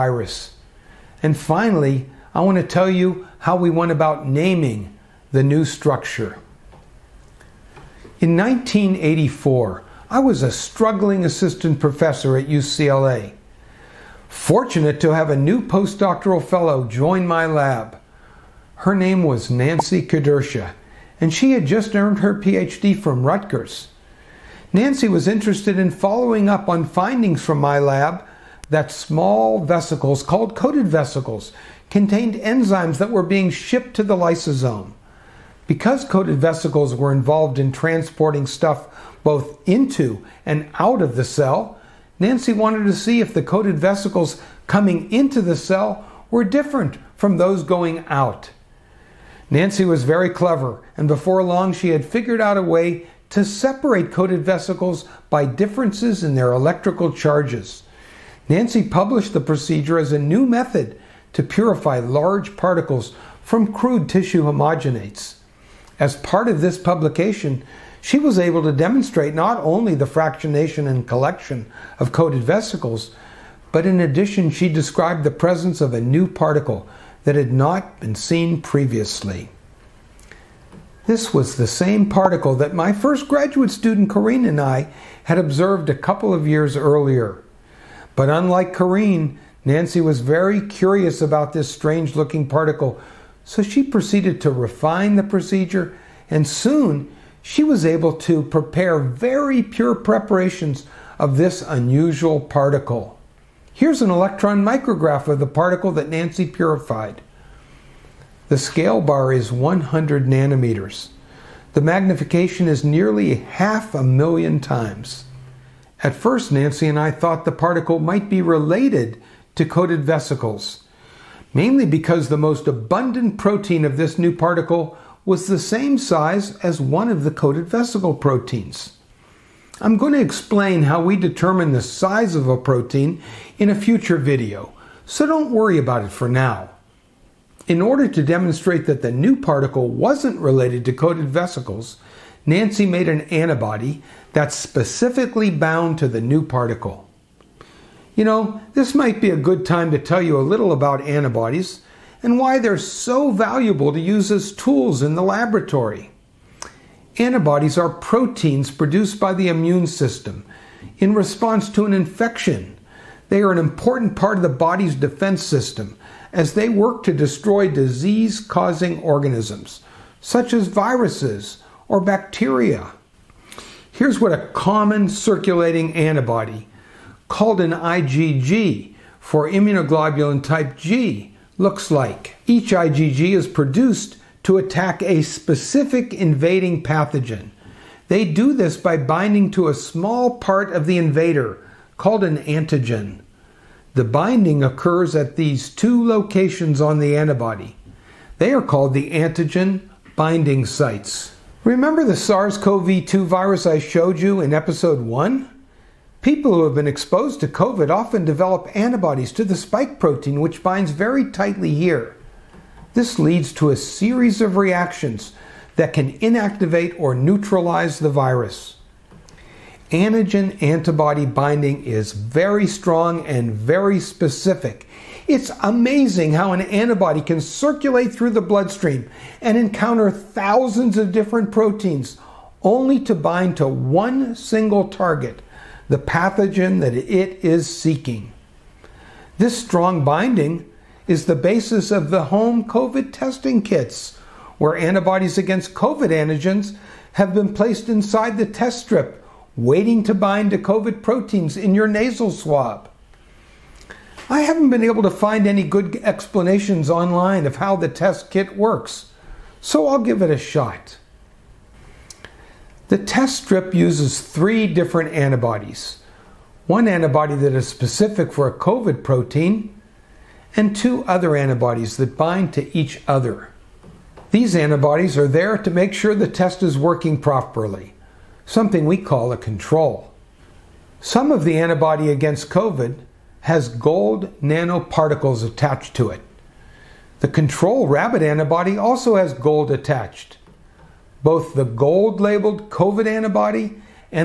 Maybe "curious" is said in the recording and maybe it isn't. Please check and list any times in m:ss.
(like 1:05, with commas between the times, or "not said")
1:30.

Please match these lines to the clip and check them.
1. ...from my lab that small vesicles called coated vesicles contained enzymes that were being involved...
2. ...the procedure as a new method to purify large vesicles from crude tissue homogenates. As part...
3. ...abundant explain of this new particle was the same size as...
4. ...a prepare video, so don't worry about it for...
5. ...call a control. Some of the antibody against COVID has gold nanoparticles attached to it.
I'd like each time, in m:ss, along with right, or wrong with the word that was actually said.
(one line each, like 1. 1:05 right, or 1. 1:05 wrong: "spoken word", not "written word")
1. 0:27 wrong: "shipped", not "involved"
2. 0:59 wrong: "particles", not "vesicles"
3. 2:02 wrong: "protein", not "explain"
4. 2:13 wrong: "future", not "prepare"
5. 4:38 right.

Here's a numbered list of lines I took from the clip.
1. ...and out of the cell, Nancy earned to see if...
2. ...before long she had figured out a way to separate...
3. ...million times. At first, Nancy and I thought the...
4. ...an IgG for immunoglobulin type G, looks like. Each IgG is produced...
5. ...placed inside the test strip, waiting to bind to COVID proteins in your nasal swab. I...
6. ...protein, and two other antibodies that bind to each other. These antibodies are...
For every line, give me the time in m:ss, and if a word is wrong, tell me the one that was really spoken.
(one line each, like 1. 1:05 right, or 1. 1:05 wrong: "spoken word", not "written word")
1. 0:40 wrong: "wanted", not "earned"
2. 0:51 right
3. 1:54 right
4. 2:57 right
5. 4:07 right
6. 4:29 right.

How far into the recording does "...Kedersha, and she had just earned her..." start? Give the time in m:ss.
0:20.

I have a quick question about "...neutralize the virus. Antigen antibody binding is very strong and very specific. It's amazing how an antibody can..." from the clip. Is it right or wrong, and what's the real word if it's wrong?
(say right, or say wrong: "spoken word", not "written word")
right.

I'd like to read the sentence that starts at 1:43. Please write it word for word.
Here's an electron micrograph of the particle that Nancy purified.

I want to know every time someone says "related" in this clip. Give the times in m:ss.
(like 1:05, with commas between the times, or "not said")
1:58, 2:20.